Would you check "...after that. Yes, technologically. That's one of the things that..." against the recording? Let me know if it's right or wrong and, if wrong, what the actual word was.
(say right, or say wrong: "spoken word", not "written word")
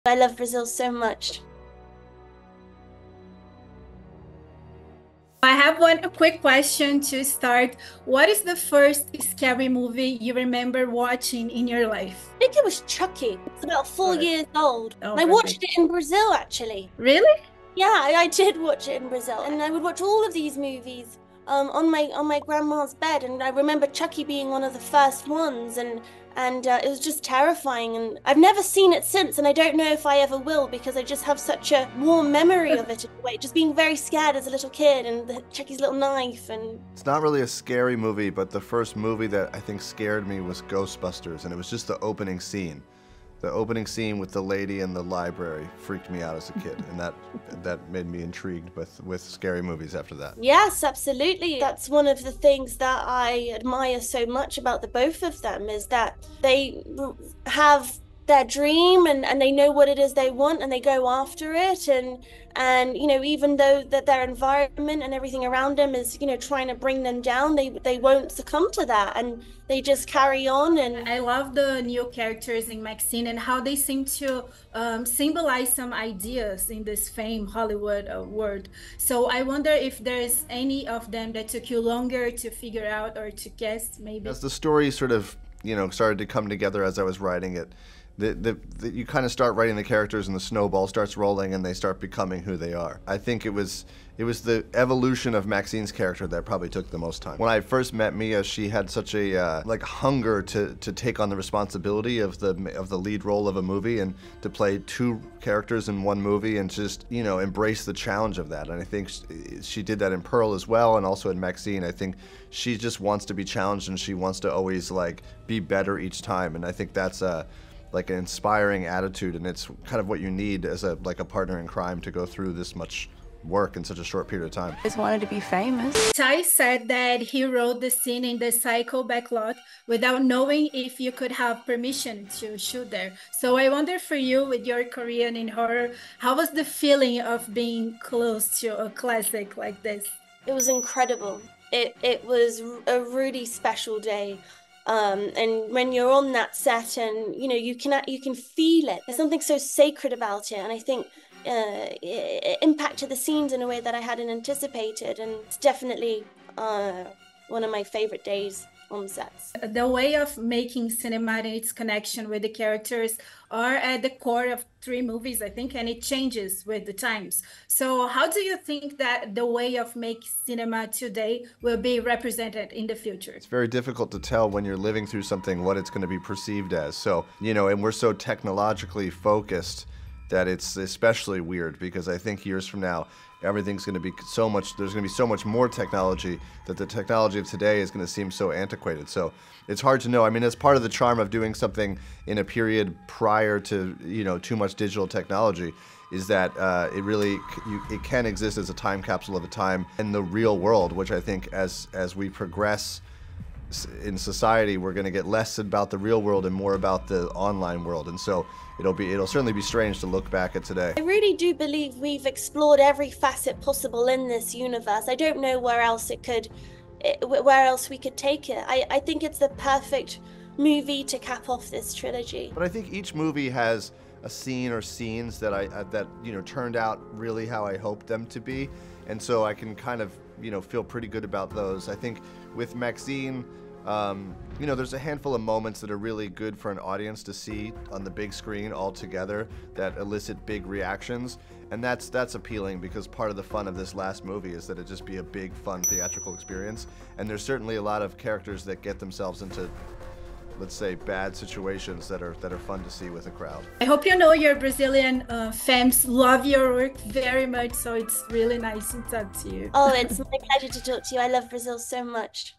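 wrong: "absolutely", not "technologically".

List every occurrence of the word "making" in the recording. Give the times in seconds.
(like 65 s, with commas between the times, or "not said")
160 s, 169 s.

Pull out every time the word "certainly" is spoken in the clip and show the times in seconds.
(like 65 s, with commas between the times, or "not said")
209 s, 247 s.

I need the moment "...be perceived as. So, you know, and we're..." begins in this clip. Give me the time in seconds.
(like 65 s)
176 s.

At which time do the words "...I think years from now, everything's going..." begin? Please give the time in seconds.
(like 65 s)
182 s.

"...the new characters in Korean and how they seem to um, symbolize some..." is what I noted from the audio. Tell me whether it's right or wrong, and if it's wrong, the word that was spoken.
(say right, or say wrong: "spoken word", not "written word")
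wrong: "MaXXXine", not "Korean".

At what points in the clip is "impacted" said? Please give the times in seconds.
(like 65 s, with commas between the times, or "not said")
152 s.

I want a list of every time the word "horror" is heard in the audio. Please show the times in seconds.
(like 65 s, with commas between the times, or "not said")
135 s.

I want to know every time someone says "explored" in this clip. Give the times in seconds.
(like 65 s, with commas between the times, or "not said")
212 s.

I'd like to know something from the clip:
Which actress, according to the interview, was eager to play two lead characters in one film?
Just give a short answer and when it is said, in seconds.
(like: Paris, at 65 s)
Mia, at 98 s.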